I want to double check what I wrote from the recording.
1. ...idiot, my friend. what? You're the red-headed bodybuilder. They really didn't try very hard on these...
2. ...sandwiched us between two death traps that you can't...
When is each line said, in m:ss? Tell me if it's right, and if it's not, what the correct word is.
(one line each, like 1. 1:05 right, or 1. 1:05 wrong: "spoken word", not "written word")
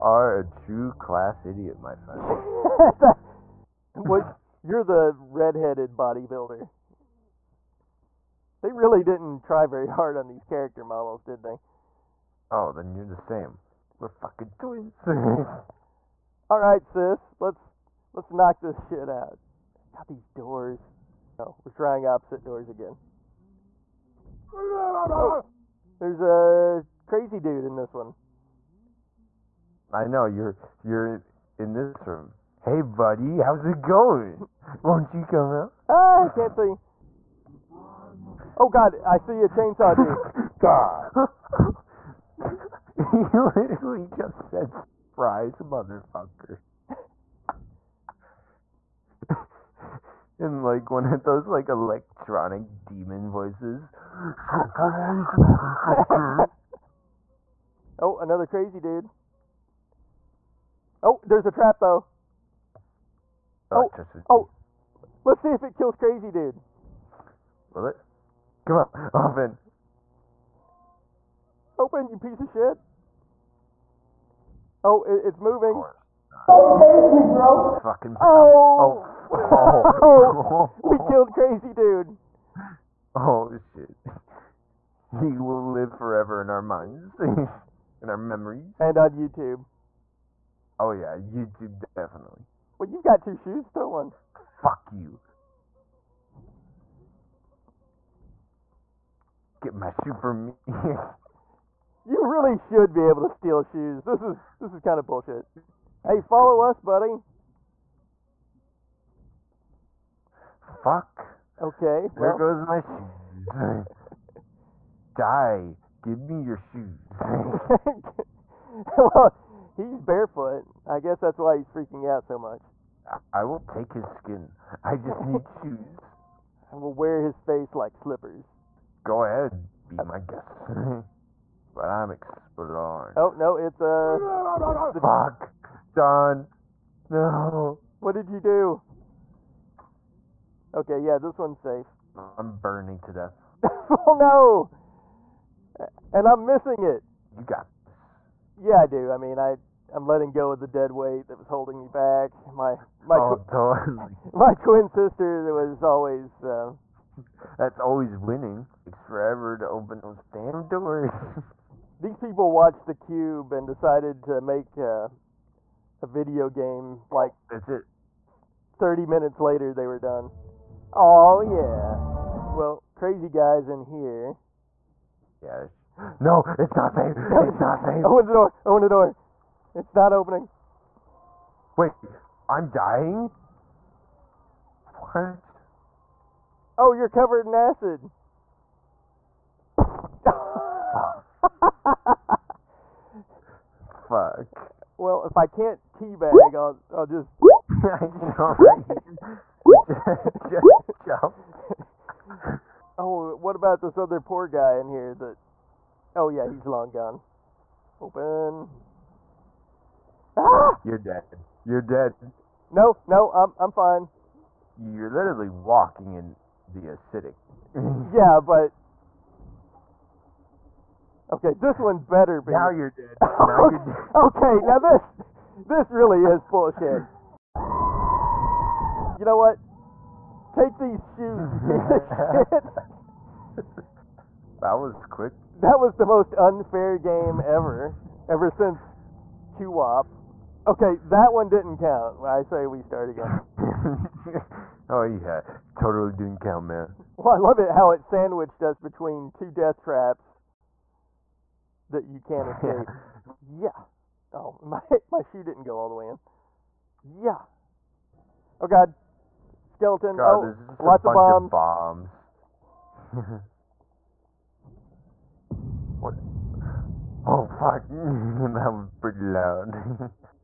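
1. 0:01 right
2. 4:08 right.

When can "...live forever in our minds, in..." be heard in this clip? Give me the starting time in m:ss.
1:25.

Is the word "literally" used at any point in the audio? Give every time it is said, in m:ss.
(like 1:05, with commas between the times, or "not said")
0:43, 3:35.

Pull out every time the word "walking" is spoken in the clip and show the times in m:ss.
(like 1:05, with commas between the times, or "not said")
3:35.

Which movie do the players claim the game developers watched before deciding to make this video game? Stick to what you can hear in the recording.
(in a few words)
The Cube.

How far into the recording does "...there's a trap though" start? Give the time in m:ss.
1:01.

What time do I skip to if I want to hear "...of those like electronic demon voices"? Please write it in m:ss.
0:51.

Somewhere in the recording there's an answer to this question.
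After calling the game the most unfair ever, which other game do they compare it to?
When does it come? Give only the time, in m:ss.
3:59.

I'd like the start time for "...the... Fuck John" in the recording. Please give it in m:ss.
2:14.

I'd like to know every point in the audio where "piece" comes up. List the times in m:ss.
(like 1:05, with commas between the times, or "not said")
1:12, 3:51.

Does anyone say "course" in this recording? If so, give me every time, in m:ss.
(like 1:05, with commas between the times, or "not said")
1:15.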